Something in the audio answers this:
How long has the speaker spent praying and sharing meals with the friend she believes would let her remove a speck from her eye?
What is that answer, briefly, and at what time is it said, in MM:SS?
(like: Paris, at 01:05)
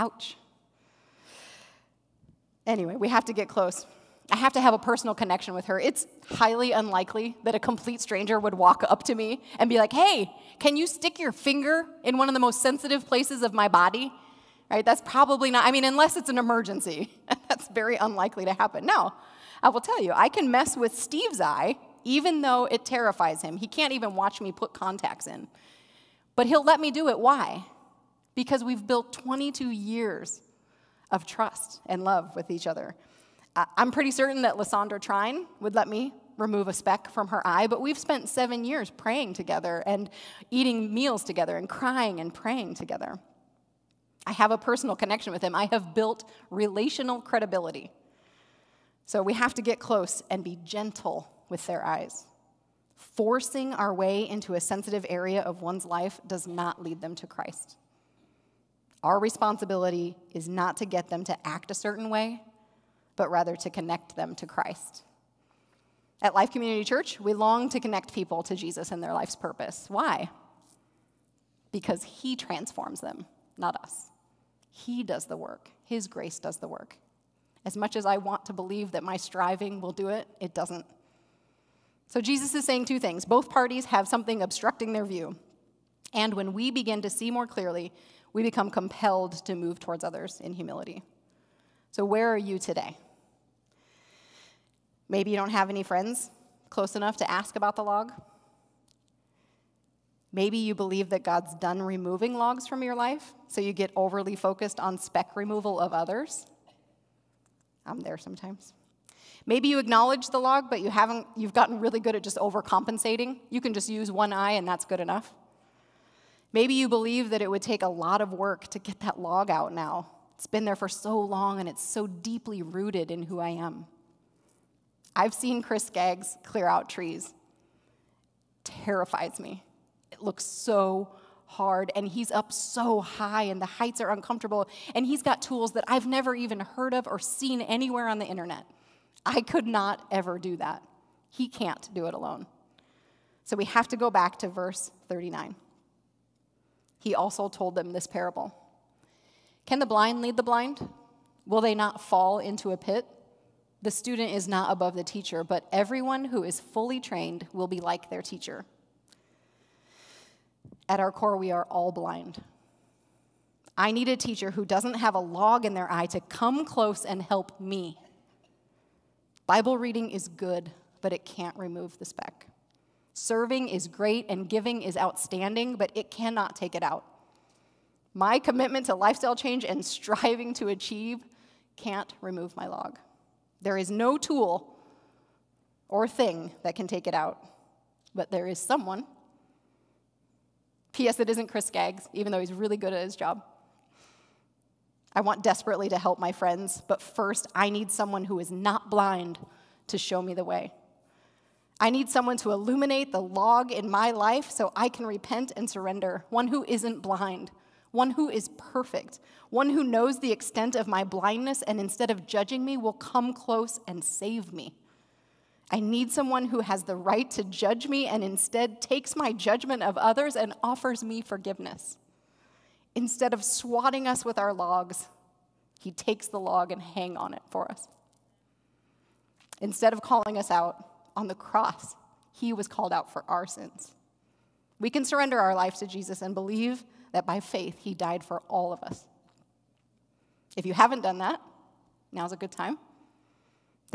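7 years, at 00:38.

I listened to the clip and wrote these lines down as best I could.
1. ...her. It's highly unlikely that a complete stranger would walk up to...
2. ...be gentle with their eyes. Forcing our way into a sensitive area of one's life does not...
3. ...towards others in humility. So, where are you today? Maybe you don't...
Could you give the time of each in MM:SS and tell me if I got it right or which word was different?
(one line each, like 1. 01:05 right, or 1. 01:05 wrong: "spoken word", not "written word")
1. 00:05 right
2. 00:50 right
3. 01:29 right.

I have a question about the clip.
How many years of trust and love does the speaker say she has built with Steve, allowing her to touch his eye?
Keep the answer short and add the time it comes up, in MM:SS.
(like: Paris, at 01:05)
22, at 00:29.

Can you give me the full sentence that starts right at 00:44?
I have a personal connection with him.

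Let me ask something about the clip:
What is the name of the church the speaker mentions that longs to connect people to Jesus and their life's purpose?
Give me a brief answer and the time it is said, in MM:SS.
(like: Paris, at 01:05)
Life Community Church, at 01:06.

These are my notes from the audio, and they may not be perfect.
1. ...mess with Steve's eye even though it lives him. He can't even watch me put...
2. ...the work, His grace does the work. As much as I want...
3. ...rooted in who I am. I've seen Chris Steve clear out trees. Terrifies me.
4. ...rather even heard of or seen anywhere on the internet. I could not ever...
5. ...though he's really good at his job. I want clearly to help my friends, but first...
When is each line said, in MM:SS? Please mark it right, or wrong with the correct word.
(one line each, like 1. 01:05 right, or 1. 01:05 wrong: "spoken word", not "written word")
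1. 00:20 wrong: "terrifies", not "lives"
2. 01:15 right
3. 02:02 wrong: "Skaggs", not "Steve"
4. 02:16 wrong: "never", not "rather"
5. 03:12 wrong: "desperately", not "clearly".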